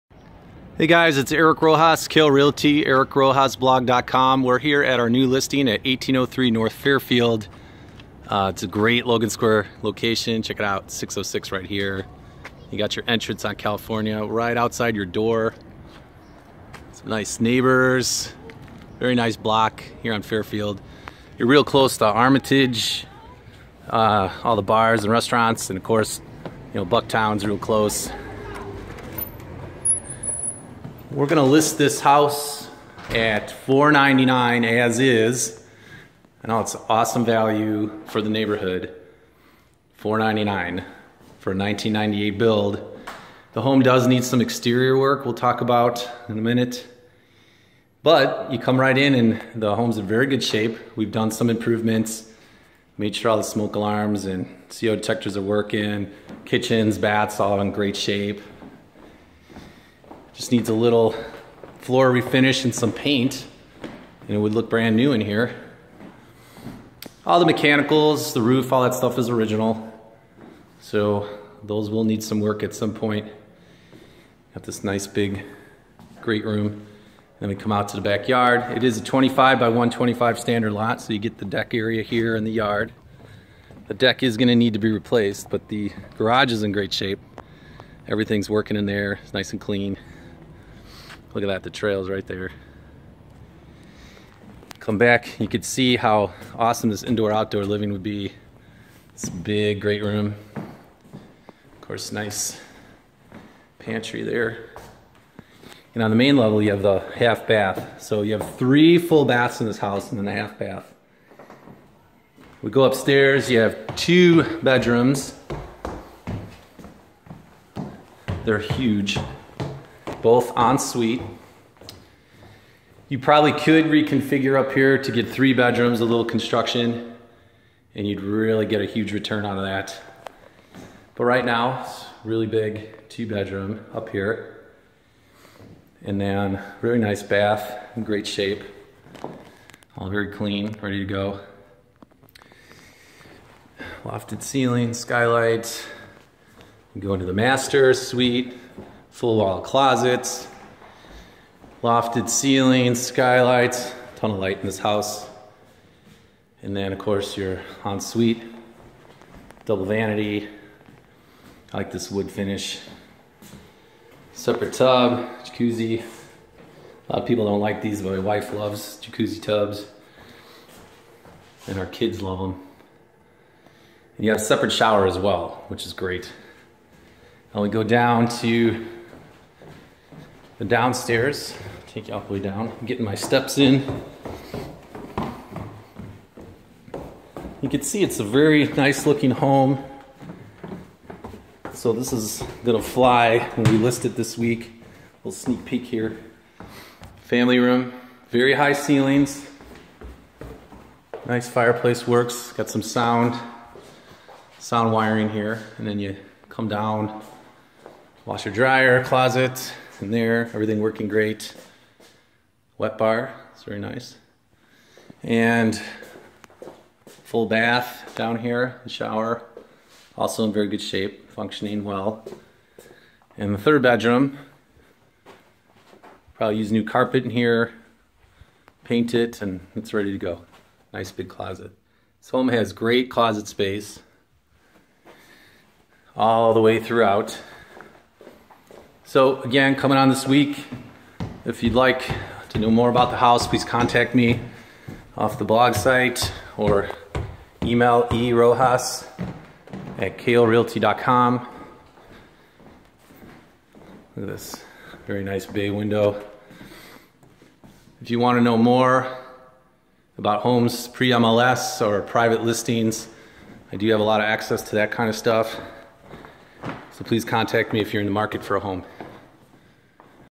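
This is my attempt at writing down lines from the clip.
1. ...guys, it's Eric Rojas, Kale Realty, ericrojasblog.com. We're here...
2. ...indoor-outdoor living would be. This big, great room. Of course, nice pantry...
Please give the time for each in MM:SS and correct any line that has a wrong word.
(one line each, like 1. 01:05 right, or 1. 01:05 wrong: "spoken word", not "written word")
1. 00:00 right
2. 01:37 right.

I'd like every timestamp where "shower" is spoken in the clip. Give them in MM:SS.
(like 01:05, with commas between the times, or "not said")
02:54, 03:38.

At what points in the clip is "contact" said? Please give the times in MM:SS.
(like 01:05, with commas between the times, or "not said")
04:03, 04:27.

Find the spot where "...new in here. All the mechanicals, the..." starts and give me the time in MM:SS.
01:04.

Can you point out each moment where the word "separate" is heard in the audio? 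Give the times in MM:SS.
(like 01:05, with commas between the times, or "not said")
02:44, 02:54.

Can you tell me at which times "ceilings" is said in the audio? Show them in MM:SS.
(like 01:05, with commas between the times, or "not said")
02:24, 02:32, 03:18.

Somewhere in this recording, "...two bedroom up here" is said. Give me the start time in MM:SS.
02:13.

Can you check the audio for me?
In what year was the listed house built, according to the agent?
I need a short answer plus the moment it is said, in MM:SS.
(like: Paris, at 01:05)
1998, at 00:41.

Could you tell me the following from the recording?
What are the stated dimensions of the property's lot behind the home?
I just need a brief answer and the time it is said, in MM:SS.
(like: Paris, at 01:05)
25 by 125, at 01:19.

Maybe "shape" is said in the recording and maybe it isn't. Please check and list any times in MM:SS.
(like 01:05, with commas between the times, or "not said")
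00:50, 00:57, 01:26, 02:18, 03:40.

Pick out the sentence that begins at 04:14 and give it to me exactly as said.
Look at this, very nice bay window.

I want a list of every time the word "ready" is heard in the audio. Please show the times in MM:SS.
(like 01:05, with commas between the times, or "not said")
02:20, 03:49.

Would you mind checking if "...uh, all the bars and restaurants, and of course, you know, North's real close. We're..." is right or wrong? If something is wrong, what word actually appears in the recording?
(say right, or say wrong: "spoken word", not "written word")
wrong: "Bucktown", not "North".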